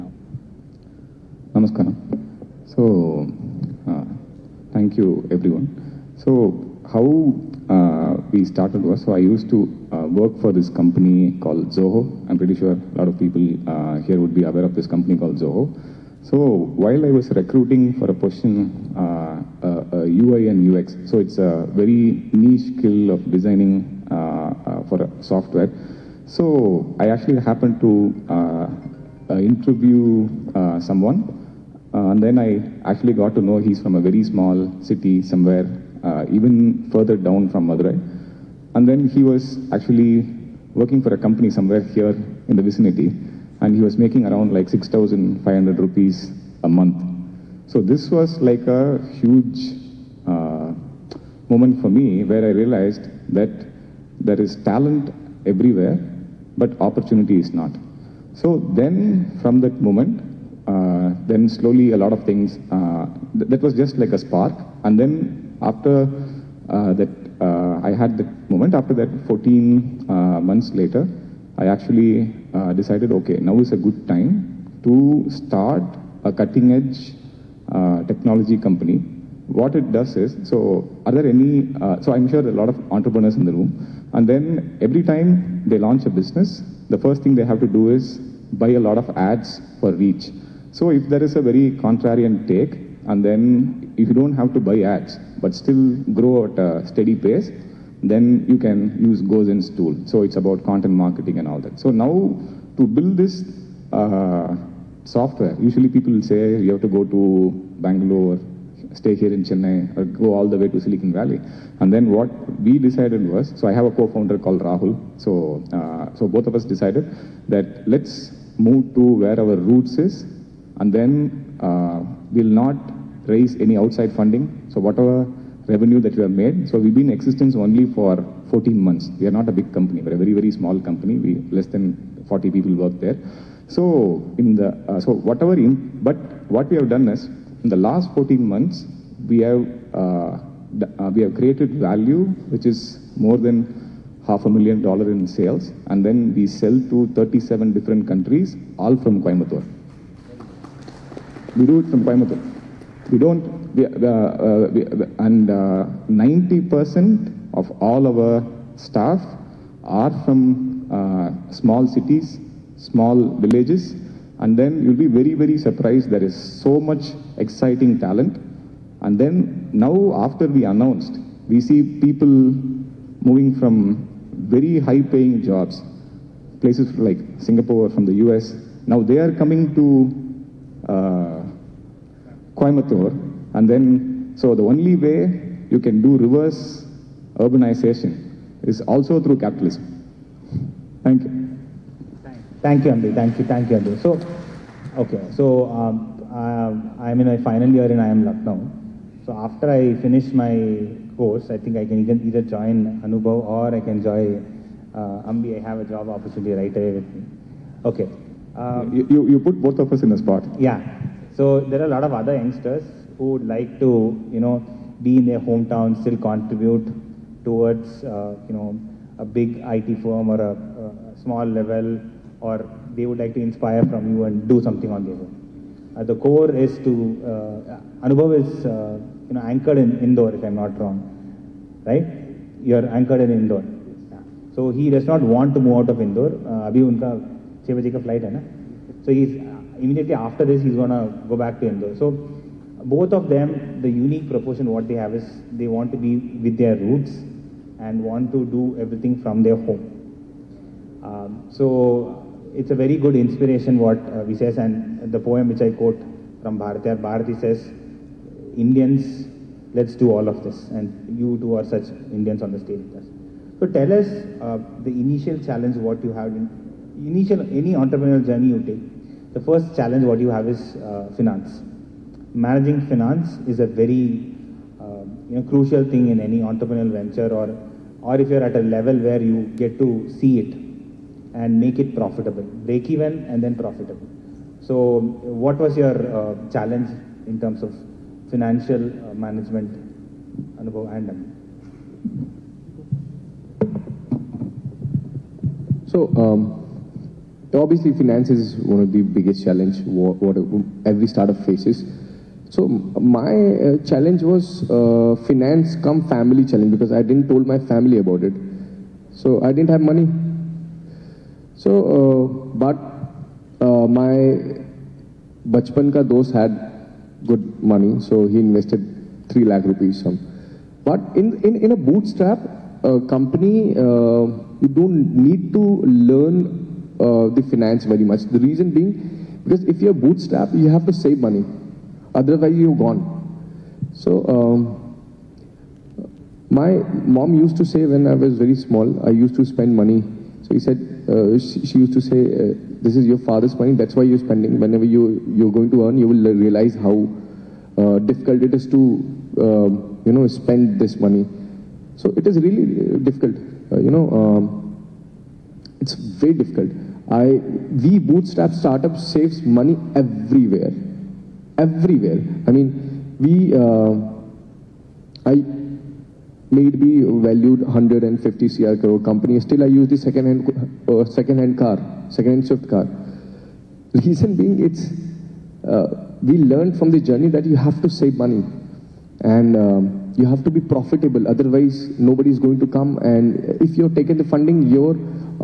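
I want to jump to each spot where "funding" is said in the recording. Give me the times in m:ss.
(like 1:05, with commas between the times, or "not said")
2:04, 6:24.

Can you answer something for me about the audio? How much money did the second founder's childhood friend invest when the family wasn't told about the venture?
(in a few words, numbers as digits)
3 lakh rupees.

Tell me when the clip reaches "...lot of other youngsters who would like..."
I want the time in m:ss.
3:31.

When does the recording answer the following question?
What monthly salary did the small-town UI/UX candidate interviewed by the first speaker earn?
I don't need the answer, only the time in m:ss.
0:44.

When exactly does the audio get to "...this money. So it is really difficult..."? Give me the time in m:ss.
5:50.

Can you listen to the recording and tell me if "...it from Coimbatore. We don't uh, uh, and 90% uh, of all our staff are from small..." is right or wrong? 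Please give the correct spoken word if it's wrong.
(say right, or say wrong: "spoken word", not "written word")
right.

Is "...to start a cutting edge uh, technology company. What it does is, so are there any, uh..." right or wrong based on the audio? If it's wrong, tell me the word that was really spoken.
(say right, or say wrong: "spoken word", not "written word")
right.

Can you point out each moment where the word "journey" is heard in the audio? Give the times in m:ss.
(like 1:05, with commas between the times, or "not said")
4:28, 6:16.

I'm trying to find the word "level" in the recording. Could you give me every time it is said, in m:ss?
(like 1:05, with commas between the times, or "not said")
3:41, 4:38.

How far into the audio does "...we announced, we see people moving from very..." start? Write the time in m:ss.
2:50.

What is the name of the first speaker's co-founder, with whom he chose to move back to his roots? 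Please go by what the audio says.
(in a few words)
Rahul.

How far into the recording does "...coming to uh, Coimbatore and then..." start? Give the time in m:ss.
2:59.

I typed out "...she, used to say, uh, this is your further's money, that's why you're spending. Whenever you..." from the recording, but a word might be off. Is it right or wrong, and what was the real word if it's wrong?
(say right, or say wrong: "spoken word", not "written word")
wrong: "father", not "further".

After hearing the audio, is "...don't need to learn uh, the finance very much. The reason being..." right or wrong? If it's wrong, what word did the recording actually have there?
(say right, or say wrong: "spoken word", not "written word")
right.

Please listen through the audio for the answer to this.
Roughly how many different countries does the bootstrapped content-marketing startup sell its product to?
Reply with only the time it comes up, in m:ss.
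2:27.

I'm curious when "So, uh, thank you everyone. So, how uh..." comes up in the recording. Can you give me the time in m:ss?
0:02.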